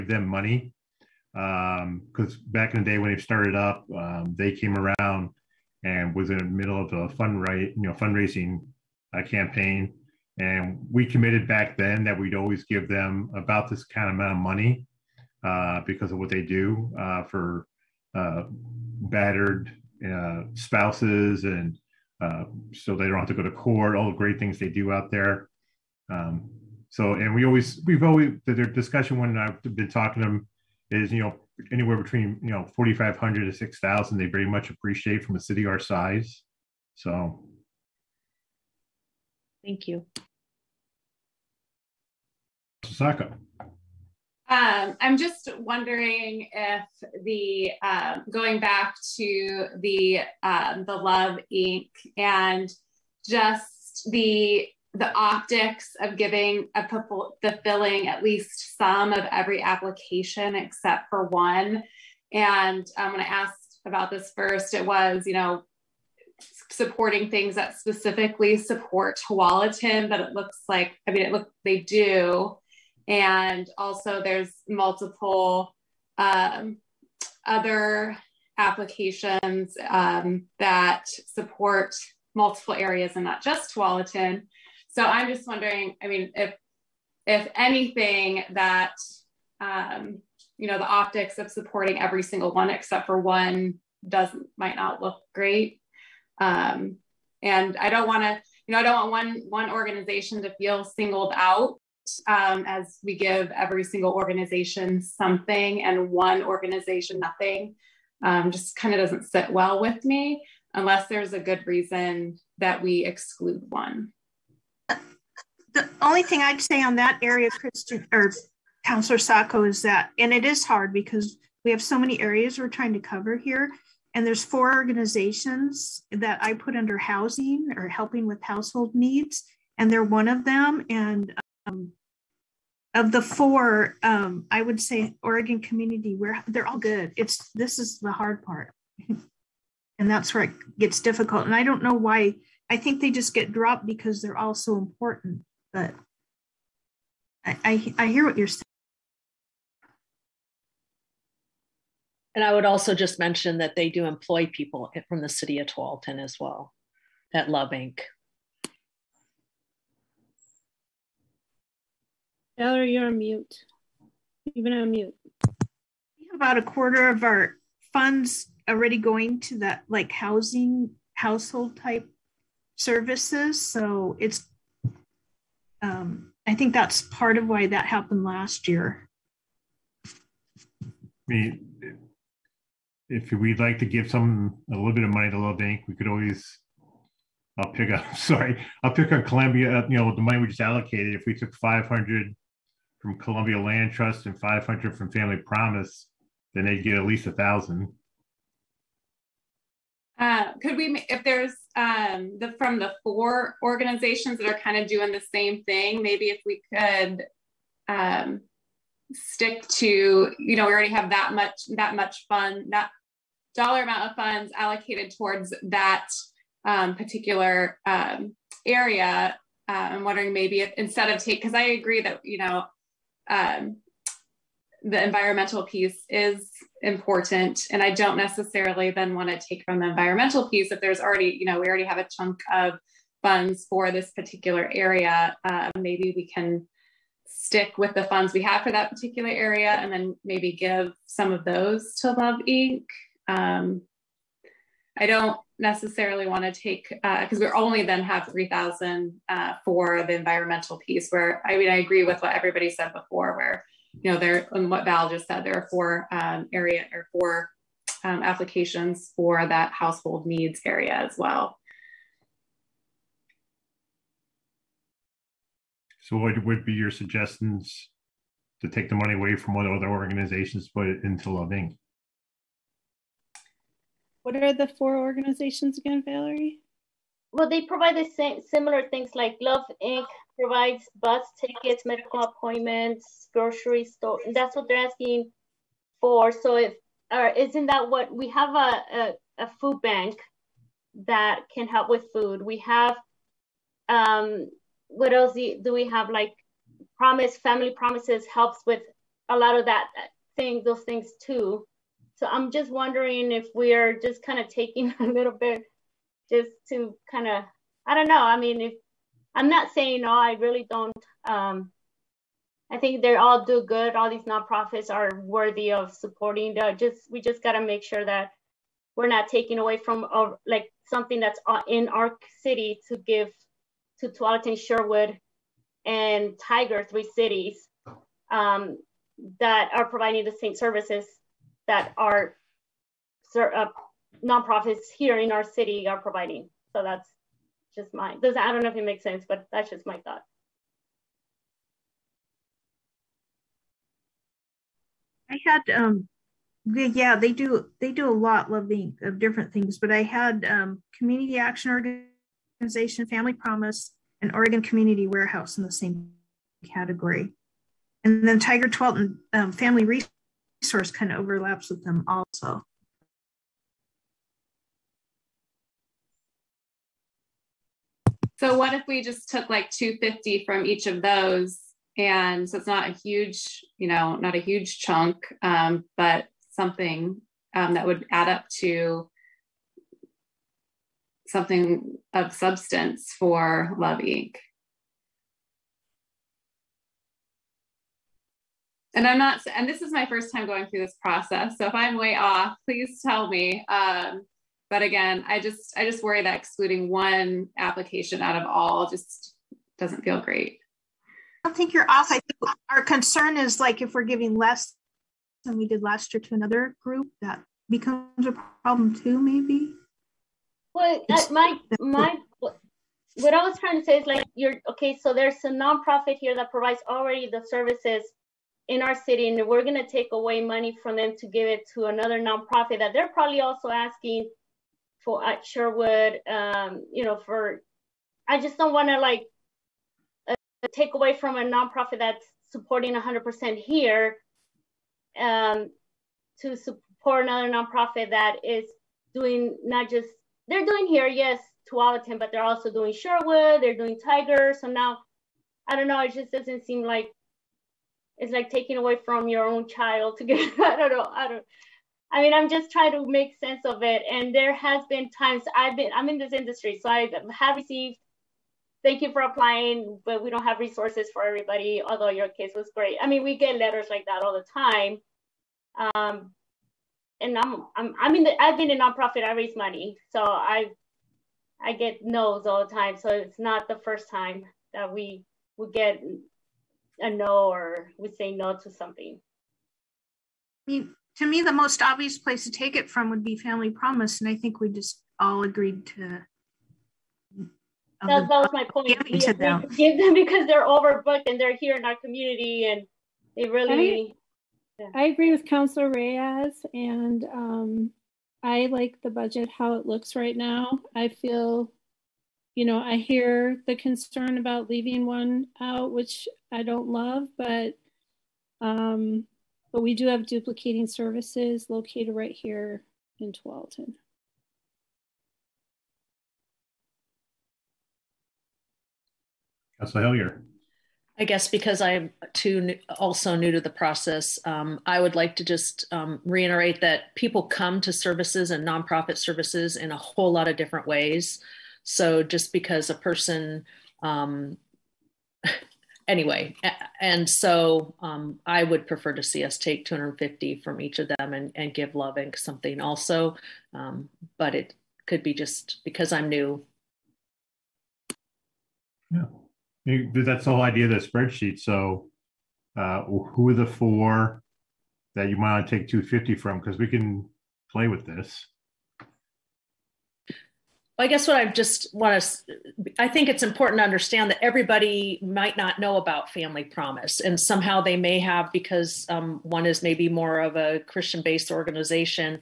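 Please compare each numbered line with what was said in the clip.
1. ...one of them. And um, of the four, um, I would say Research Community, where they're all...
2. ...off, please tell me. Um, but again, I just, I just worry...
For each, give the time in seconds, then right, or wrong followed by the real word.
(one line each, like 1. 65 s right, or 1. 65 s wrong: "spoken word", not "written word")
1. 130 s wrong: "Oregon", not "Research"
2. 392 s right.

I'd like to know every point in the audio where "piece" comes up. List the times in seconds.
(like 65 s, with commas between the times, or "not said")
225 s, 230 s, 250 s.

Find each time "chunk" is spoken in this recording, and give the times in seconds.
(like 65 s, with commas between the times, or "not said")
232 s, 374 s.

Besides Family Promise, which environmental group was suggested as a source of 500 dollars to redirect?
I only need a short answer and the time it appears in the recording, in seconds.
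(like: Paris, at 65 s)
Columbia Land Trust, at 193 s.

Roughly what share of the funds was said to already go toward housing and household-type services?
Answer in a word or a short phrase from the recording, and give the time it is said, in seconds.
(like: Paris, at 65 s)
a quarter, at 166 s.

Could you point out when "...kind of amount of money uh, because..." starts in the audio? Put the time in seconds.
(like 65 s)
13 s.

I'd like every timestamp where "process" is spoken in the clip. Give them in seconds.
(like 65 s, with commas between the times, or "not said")
391 s, 523 s.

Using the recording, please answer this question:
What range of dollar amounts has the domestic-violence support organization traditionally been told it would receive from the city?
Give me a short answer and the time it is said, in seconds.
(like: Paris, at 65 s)
4500 to 6000, at 32 s.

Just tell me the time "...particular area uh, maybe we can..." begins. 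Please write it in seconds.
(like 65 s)
234 s.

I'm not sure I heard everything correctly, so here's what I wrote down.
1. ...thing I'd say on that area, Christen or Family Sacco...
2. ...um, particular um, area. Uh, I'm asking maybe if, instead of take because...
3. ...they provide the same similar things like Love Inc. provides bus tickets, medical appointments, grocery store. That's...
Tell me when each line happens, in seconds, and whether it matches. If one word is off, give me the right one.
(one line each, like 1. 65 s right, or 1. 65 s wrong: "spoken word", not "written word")
1. 116 s wrong: "Counselor", not "Family"
2. 216 s wrong: "wondering", not "asking"
3. 277 s right.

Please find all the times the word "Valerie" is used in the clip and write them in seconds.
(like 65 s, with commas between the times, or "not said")
162 s, 276 s.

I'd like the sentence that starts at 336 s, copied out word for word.
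So that's just my, Those I don't know if it makes sense, but that's just my thought.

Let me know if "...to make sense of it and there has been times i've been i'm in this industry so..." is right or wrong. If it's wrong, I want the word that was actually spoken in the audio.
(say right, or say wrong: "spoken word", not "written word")
right.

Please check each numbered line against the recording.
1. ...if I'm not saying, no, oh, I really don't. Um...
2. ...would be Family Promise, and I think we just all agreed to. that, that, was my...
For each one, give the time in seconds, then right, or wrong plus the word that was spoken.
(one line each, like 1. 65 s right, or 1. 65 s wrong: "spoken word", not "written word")
1. 308 s right
2. 483 s right.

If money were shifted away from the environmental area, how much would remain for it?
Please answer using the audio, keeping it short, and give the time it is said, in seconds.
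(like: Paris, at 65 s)
3000, at 248 s.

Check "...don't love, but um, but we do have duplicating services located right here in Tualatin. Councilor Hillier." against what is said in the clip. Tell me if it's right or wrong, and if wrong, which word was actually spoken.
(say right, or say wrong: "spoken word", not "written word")
right.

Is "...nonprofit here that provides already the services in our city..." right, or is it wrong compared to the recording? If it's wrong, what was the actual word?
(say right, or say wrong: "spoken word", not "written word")
right.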